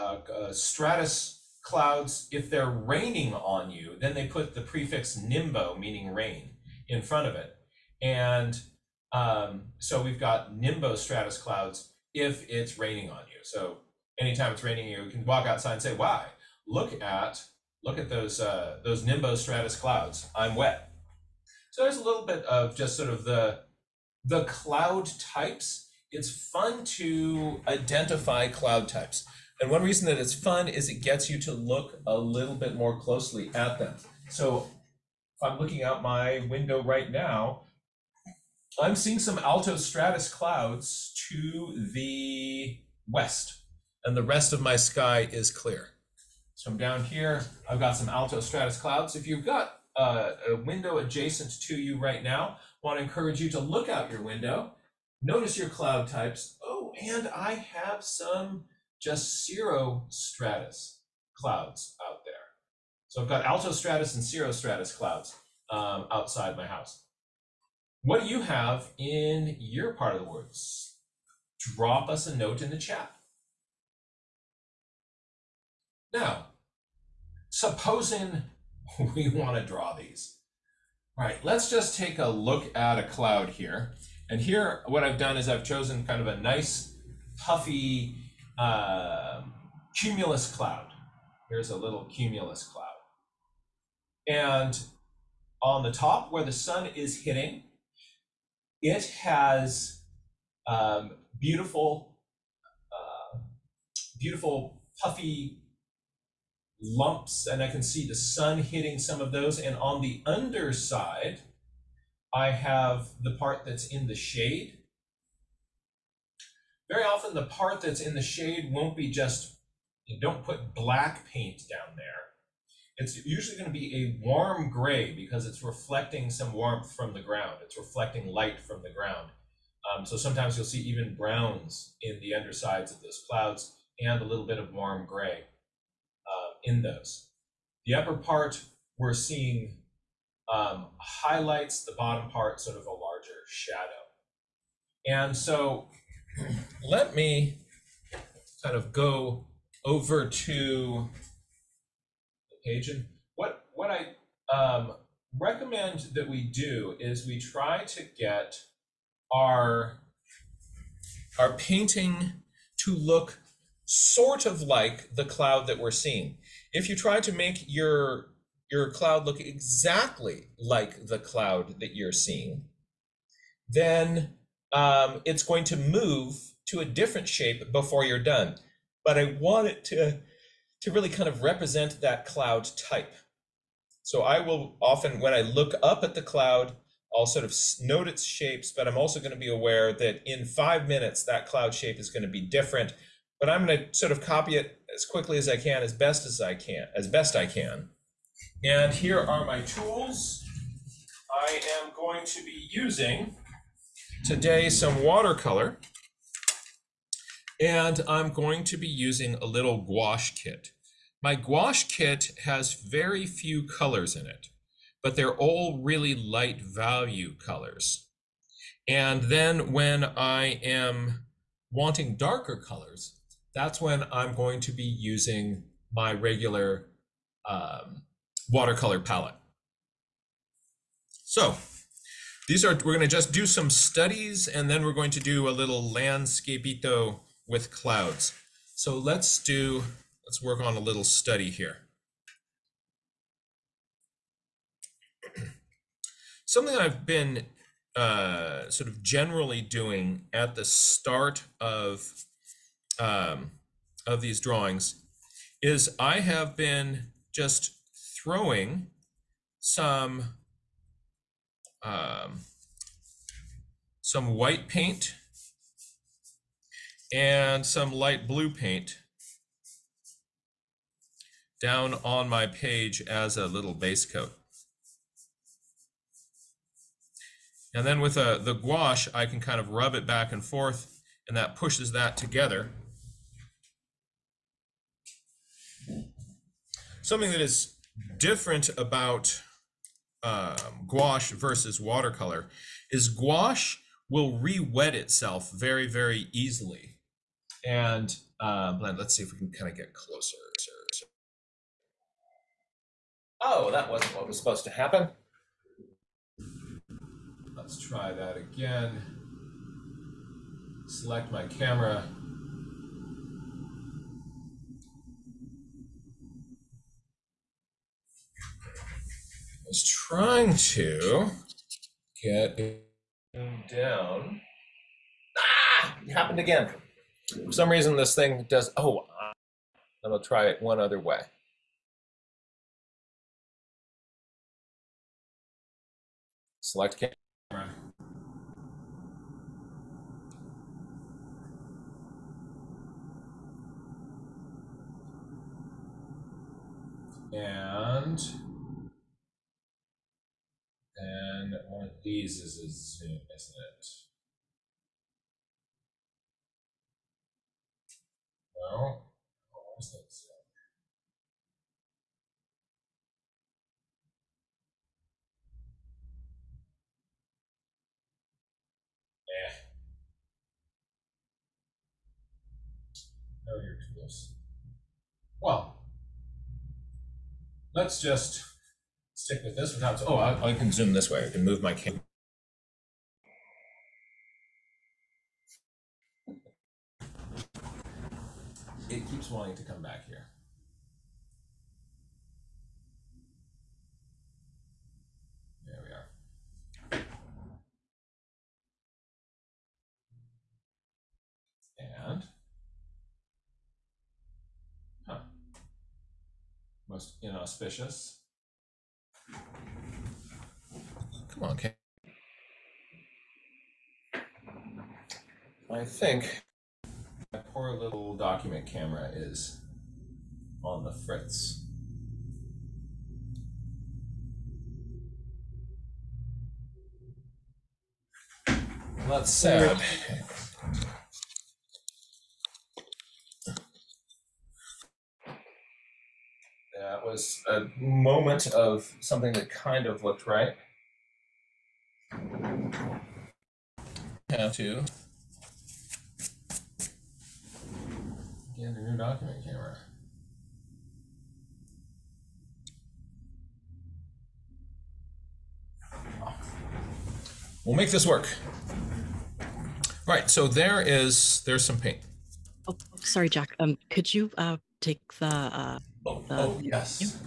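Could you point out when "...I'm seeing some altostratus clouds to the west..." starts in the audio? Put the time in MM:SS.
00:38.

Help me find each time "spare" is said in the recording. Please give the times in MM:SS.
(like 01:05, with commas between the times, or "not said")
not said.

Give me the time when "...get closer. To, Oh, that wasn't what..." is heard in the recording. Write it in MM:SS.
04:59.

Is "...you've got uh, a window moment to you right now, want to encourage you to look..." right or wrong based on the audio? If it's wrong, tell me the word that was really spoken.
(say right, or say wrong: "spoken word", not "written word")
wrong: "adjacent", not "moment".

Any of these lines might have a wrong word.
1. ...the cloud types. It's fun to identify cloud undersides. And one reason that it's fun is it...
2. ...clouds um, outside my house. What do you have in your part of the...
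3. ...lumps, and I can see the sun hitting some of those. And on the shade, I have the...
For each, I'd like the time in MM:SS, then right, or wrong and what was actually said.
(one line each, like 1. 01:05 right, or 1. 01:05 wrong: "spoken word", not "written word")
1. 00:24 wrong: "types", not "undersides"
2. 01:04 right
3. 01:46 wrong: "underside", not "shade".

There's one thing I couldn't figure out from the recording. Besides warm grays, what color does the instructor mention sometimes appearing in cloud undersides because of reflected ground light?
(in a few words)
browns.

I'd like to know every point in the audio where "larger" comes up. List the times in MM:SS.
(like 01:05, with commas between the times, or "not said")
02:22.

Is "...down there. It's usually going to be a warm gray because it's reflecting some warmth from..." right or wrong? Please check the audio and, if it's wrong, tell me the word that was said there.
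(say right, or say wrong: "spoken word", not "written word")
right.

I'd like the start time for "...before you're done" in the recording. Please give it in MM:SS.
02:57.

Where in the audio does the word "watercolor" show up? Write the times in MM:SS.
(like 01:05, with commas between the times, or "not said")
03:25, 03:48, 04:51.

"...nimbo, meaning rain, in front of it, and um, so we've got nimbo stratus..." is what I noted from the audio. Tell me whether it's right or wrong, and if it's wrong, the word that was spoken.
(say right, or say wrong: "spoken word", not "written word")
right.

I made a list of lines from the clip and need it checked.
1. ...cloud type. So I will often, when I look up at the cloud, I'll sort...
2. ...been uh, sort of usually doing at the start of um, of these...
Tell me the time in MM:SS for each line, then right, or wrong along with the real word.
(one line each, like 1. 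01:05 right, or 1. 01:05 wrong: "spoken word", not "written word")
1. 03:02 right
2. 04:07 wrong: "generally", not "usually".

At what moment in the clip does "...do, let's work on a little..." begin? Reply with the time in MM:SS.
03:59.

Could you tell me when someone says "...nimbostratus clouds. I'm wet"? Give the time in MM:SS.
00:19.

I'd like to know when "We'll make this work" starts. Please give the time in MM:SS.
07:37.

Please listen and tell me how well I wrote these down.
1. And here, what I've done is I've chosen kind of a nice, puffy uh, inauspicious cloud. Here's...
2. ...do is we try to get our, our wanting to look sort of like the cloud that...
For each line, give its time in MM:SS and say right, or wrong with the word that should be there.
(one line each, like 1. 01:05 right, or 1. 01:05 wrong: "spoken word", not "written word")
1. 01:24 wrong: "cumulus", not "inauspicious"
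2. 02:36 wrong: "painting", not "wanting".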